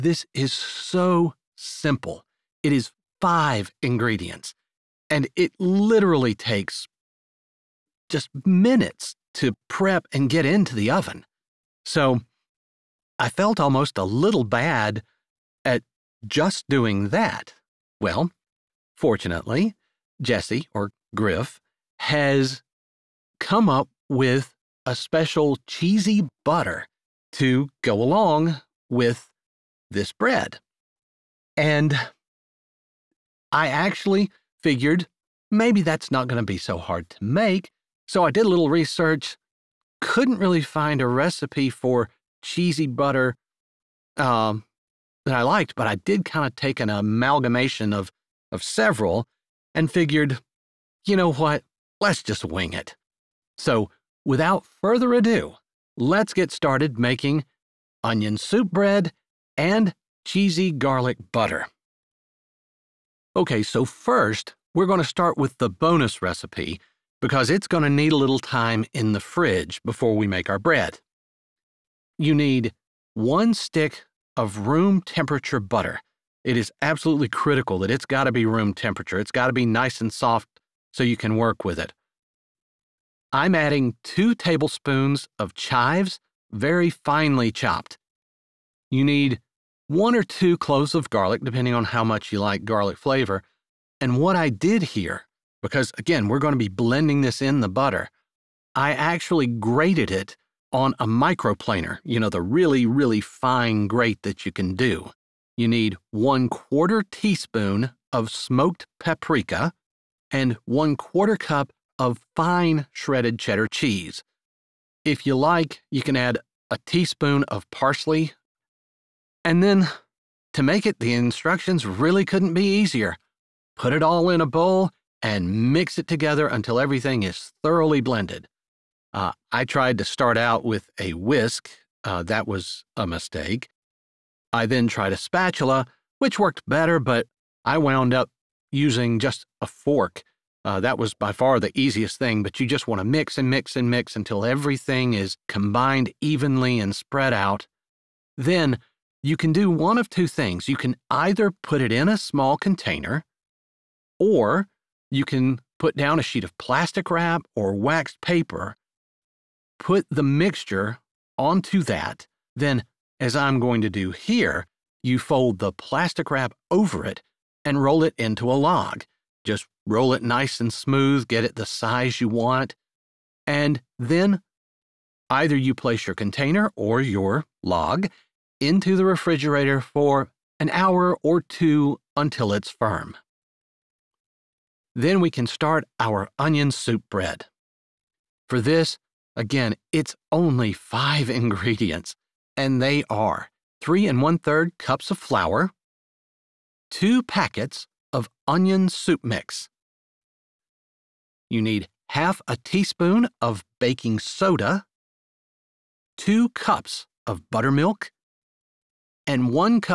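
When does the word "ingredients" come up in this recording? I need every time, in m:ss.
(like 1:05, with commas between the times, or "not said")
0:03, 3:11.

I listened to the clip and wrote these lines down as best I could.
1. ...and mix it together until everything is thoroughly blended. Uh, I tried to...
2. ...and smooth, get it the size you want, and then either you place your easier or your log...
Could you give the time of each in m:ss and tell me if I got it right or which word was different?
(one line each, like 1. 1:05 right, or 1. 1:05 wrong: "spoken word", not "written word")
1. 2:05 right
2. 2:50 wrong: "container", not "easier".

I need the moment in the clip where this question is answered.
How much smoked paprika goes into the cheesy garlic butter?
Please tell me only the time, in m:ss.
1:46.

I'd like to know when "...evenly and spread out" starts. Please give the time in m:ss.
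2:26.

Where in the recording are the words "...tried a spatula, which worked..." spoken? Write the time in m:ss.
2:14.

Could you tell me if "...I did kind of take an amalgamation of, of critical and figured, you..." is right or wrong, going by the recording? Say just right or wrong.
wrong.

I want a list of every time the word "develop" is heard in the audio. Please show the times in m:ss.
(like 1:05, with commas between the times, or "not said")
not said.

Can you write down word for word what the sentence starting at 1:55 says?
If you like, you can add a teaspoon of parsley.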